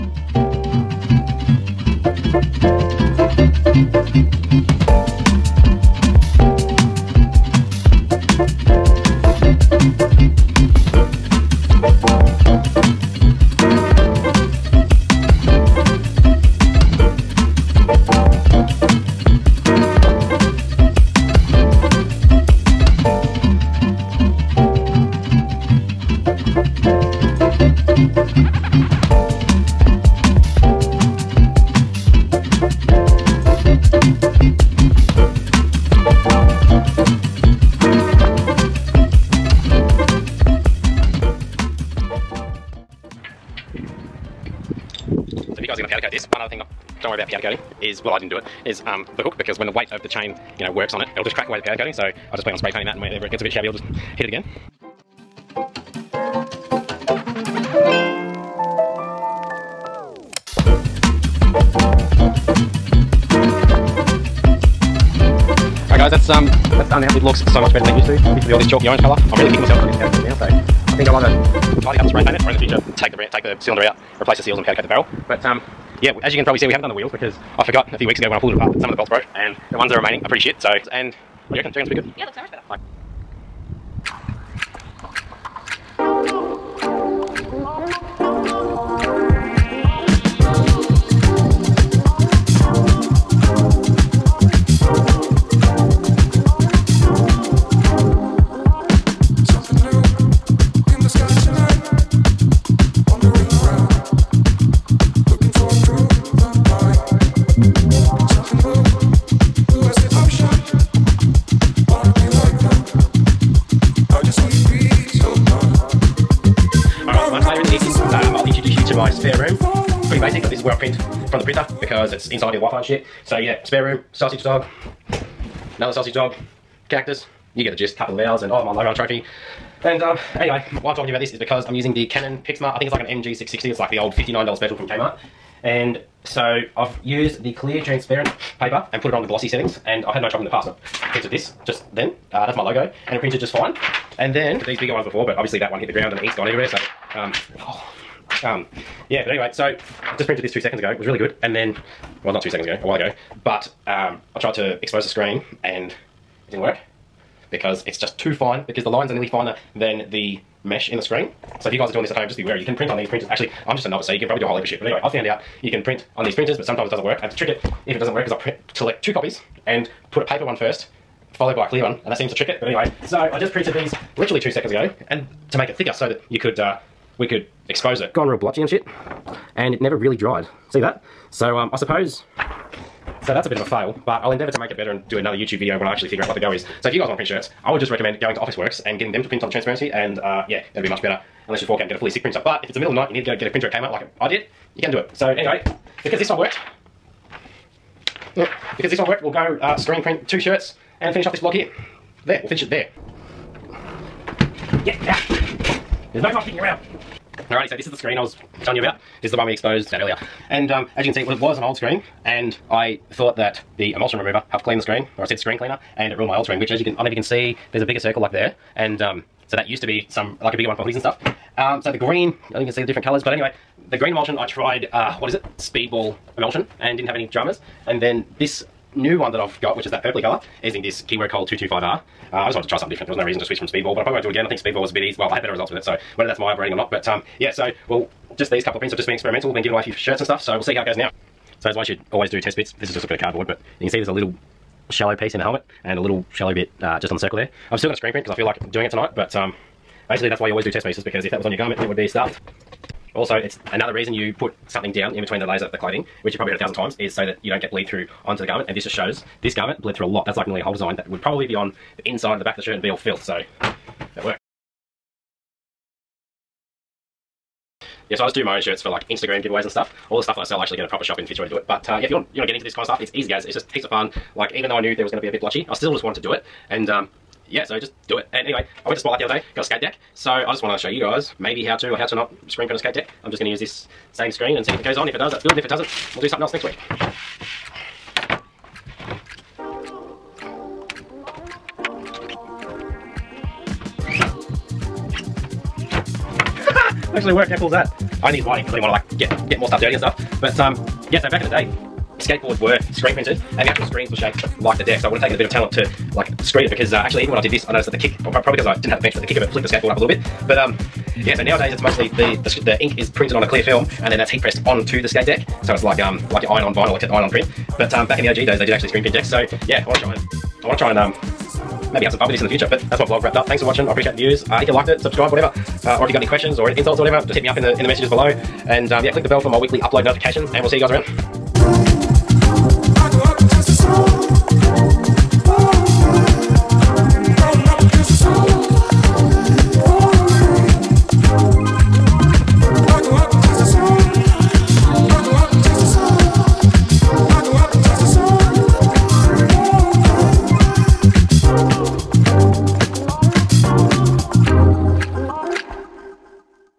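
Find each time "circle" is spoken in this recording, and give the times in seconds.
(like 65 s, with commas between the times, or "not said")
217 s, 247 s.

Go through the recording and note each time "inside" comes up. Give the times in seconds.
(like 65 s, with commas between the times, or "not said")
122 s, 262 s.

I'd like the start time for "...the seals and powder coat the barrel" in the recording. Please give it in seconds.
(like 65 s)
74 s.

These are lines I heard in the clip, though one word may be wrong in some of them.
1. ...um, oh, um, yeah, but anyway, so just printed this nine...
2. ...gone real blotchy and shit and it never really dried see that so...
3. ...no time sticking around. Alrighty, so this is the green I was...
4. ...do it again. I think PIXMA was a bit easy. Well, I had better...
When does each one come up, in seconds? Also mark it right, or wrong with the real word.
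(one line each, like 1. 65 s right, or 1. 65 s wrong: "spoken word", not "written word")
1. 147 s wrong: "two", not "nine"
2. 178 s right
3. 206 s wrong: "screen", not "green"
4. 234 s wrong: "Speedball", not "PIXMA".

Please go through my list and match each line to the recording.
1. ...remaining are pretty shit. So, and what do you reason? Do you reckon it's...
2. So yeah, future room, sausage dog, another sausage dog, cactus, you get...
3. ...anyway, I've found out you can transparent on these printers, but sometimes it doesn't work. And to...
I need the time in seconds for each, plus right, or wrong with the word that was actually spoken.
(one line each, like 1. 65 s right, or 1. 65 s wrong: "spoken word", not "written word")
1. 79 s wrong: "reckon", not "reason"
2. 123 s wrong: "spare", not "future"
3. 164 s wrong: "print", not "transparent".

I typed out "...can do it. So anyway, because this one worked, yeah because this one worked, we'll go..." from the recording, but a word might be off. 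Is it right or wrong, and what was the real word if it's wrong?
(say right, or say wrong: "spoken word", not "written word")
right.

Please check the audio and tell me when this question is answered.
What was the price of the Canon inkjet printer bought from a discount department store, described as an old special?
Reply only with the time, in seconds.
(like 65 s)
134 s.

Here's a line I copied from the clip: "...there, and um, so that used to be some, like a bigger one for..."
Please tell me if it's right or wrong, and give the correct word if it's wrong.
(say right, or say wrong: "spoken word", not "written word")
right.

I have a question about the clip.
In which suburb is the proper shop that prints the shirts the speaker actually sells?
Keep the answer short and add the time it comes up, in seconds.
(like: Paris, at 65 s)
Fitzroy, at 271 s.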